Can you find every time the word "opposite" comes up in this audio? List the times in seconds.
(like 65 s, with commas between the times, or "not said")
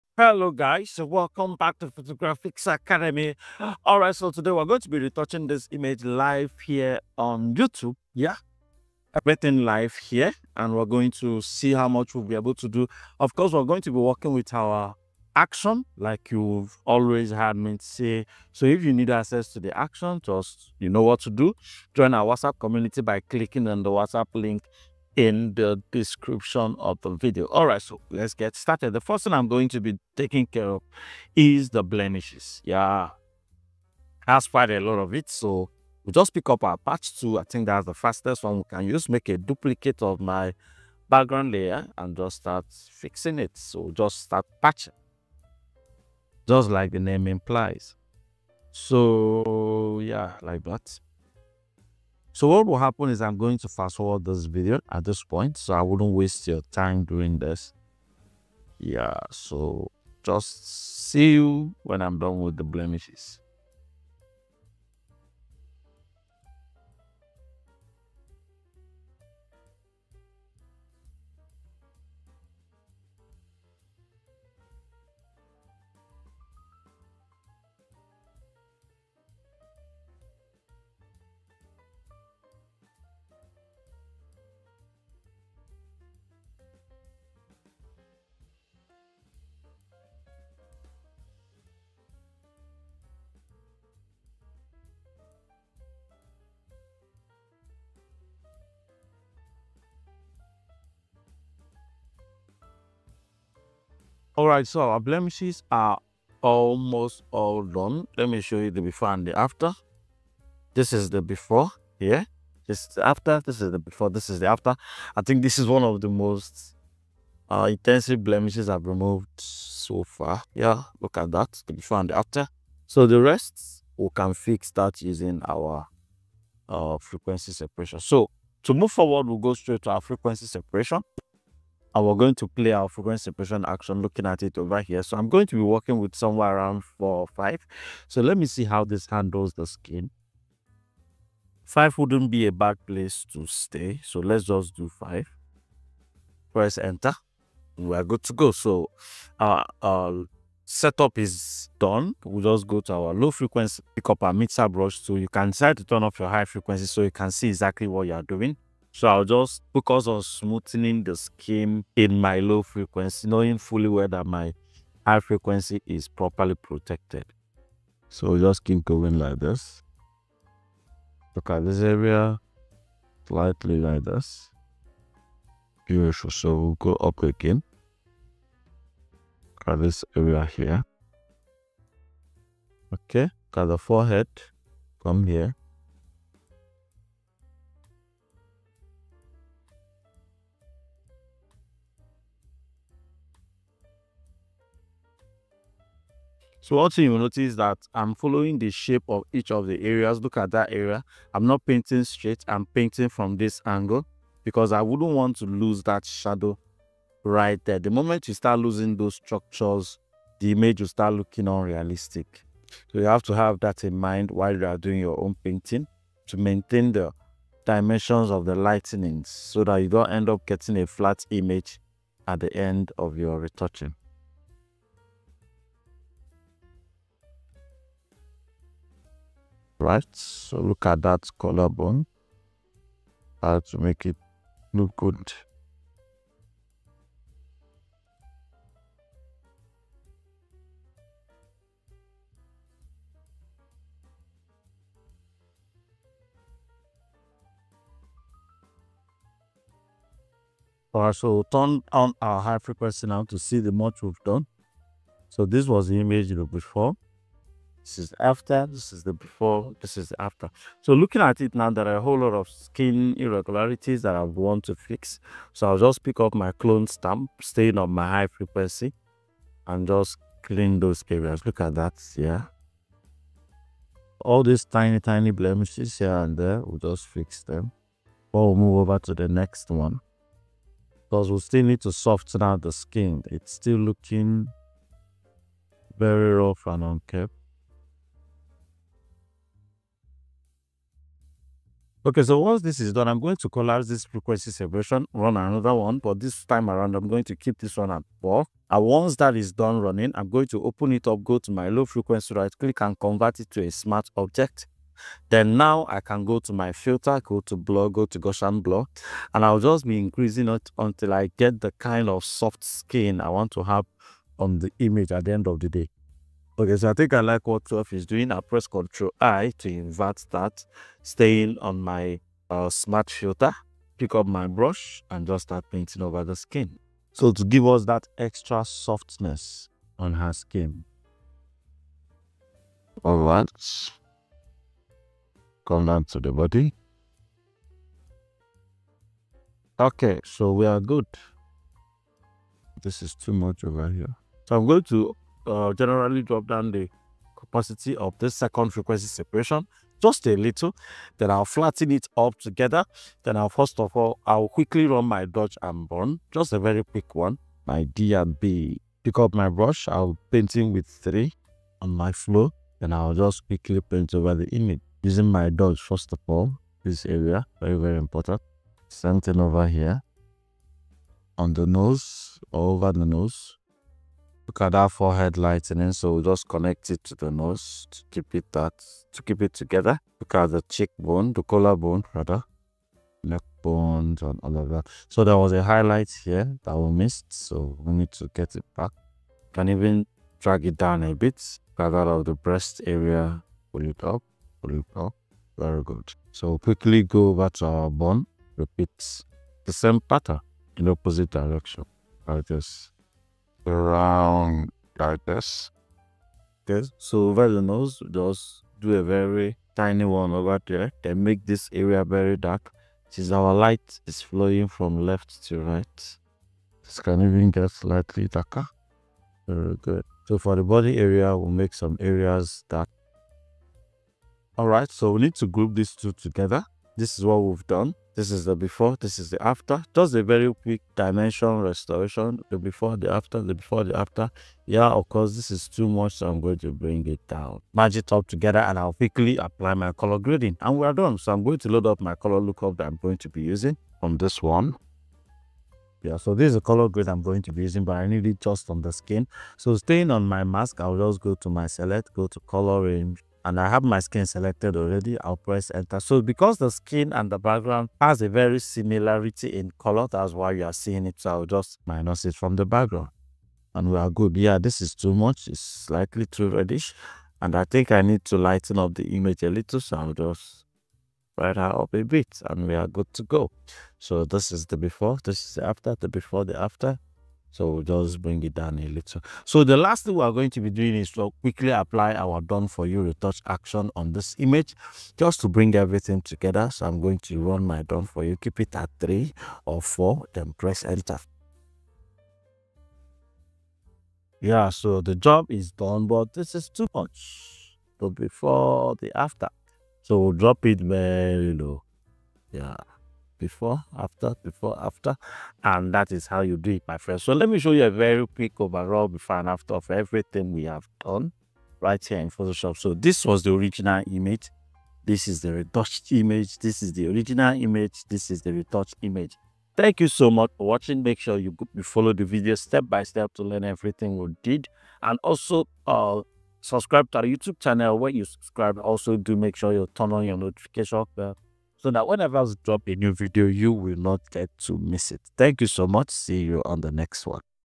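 400 s.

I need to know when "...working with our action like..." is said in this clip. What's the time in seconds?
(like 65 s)
13 s.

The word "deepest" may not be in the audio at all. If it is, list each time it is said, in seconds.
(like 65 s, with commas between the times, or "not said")
not said.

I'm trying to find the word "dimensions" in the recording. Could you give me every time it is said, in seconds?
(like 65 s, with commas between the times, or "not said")
217 s, 430 s.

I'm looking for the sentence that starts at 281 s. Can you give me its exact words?
Because we still need to soften out the skin.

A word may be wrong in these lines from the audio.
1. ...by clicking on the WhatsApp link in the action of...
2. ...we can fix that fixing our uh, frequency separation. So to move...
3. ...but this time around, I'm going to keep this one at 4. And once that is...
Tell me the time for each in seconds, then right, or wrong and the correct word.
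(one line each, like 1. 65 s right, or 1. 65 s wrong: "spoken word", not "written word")
1. 23 s wrong: "description", not "action"
2. 123 s wrong: "using", not "fixing"
3. 295 s right.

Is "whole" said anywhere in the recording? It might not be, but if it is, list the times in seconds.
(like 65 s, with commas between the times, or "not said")
262 s.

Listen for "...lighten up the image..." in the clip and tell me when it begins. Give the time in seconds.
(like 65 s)
468 s.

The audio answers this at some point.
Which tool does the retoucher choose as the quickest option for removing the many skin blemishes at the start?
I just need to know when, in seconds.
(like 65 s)
36 s.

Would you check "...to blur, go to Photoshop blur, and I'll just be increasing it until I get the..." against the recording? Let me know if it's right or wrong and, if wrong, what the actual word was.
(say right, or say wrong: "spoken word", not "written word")
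wrong: "Gaussian", not "Photoshop".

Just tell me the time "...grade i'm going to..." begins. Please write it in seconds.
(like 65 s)
446 s.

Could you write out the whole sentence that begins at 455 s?
So because the skin and the background has a very similarity in color, that's why you are seeing it.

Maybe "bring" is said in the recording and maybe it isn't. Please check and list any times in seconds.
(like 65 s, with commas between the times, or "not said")
436 s, 478 s, 485 s.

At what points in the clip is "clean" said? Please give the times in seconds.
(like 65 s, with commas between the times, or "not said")
270 s.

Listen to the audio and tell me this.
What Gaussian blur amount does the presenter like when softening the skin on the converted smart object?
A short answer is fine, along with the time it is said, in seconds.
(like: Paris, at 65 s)
12, at 317 s.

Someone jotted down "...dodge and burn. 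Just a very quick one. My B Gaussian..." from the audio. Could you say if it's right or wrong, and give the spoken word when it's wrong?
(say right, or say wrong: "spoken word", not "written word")
wrong: "Pick", not "Gaussian".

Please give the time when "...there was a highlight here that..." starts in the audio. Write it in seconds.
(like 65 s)
385 s.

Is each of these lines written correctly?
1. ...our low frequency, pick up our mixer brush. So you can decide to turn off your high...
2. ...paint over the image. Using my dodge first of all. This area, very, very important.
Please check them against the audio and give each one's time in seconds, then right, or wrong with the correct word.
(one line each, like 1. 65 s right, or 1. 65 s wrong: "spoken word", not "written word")
1. 152 s right
2. 363 s right.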